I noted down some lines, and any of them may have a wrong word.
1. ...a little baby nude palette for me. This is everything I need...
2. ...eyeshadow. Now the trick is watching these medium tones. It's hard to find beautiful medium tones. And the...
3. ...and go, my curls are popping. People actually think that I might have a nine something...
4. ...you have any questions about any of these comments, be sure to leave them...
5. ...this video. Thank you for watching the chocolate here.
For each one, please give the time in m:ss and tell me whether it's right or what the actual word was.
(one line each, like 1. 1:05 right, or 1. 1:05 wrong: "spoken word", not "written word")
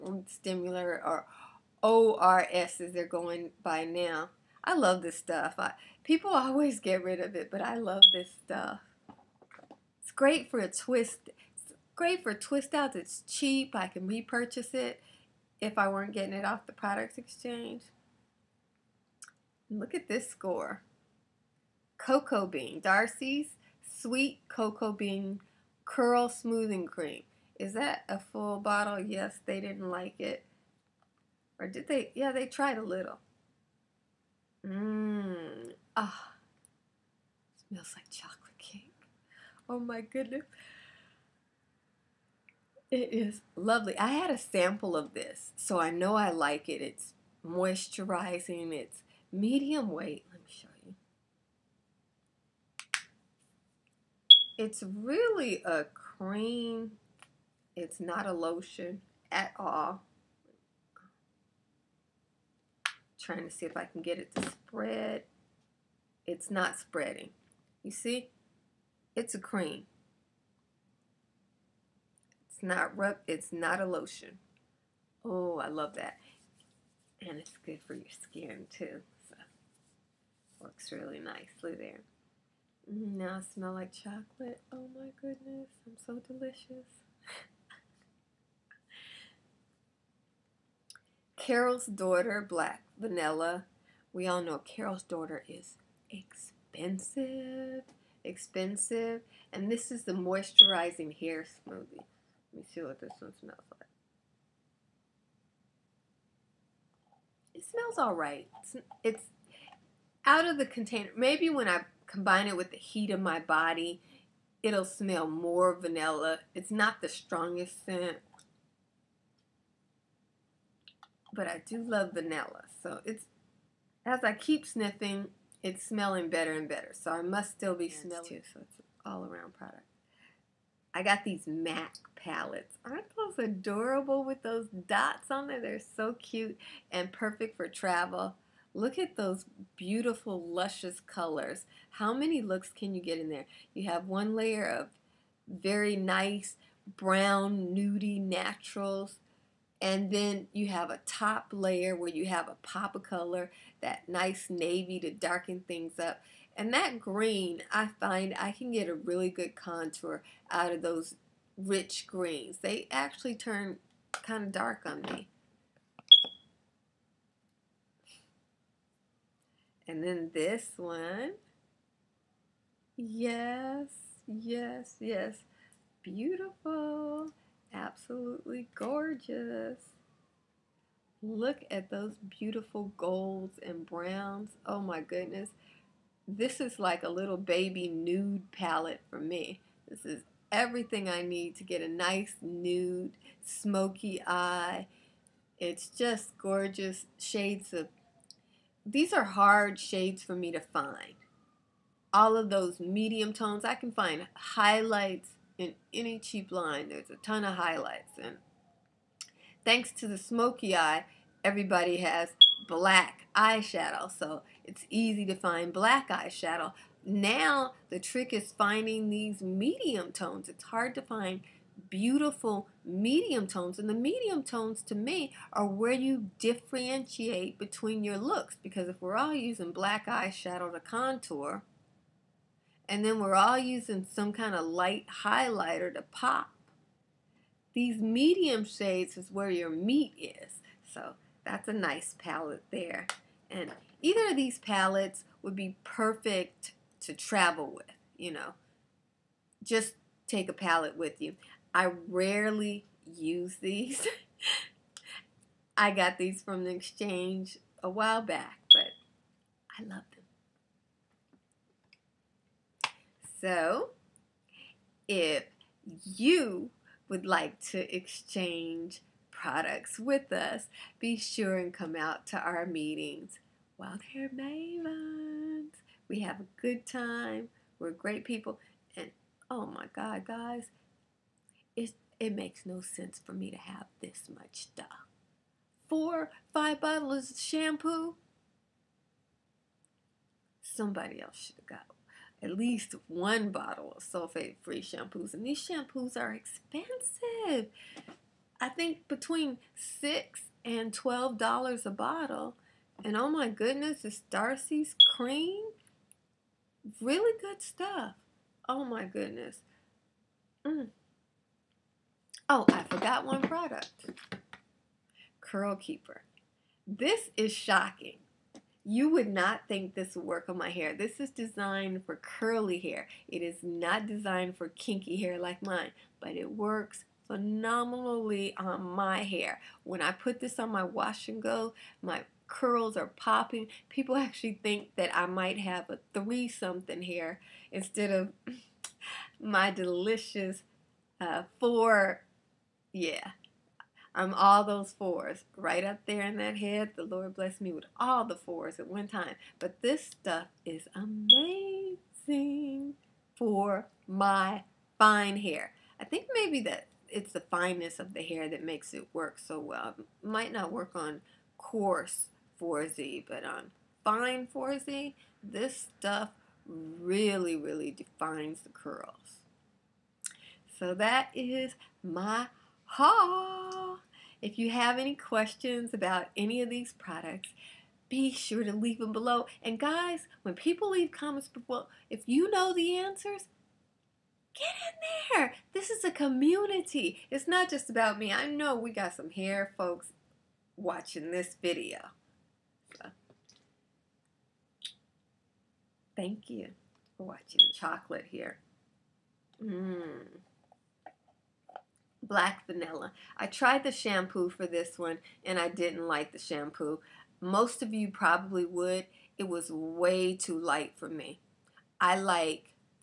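1. 3:07 right
2. 3:36 wrong: "finding", not "watching"
3. 5:31 wrong: "three", not "nine"
4. 6:14 wrong: "products", not "comments"
5. 6:31 right.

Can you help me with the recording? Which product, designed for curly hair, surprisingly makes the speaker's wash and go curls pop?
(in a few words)
Curl Keeper.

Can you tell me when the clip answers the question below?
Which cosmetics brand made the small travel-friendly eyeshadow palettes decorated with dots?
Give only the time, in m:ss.
2:11.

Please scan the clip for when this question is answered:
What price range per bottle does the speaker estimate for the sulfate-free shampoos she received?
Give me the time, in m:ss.
4:59.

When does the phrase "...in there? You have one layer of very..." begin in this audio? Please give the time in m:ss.
2:23.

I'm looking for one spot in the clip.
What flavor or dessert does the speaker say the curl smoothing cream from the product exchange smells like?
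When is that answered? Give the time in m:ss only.
0:38.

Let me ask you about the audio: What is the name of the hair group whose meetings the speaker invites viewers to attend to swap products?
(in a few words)
Wild Hair Mavens.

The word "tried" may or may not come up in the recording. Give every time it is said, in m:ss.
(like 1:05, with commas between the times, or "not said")
0:32, 6:43.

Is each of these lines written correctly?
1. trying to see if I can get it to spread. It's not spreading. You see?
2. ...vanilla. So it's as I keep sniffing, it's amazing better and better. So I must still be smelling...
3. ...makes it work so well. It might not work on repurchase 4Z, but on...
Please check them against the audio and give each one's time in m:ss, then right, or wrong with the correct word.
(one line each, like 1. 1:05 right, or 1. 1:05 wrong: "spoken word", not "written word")
1. 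1:03 right
2. 2:02 wrong: "smelling", not "amazing"
3. 5:58 wrong: "coarse", not "repurchase".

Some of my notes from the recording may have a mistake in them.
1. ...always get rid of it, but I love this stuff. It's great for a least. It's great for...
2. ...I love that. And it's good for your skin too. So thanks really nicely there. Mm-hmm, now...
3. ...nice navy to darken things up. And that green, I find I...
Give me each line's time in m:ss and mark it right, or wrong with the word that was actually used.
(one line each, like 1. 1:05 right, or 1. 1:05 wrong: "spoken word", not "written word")
1. 0:06 wrong: "twist", not "least"
2. 1:15 wrong: "works", not "thanks"
3. 2:34 right.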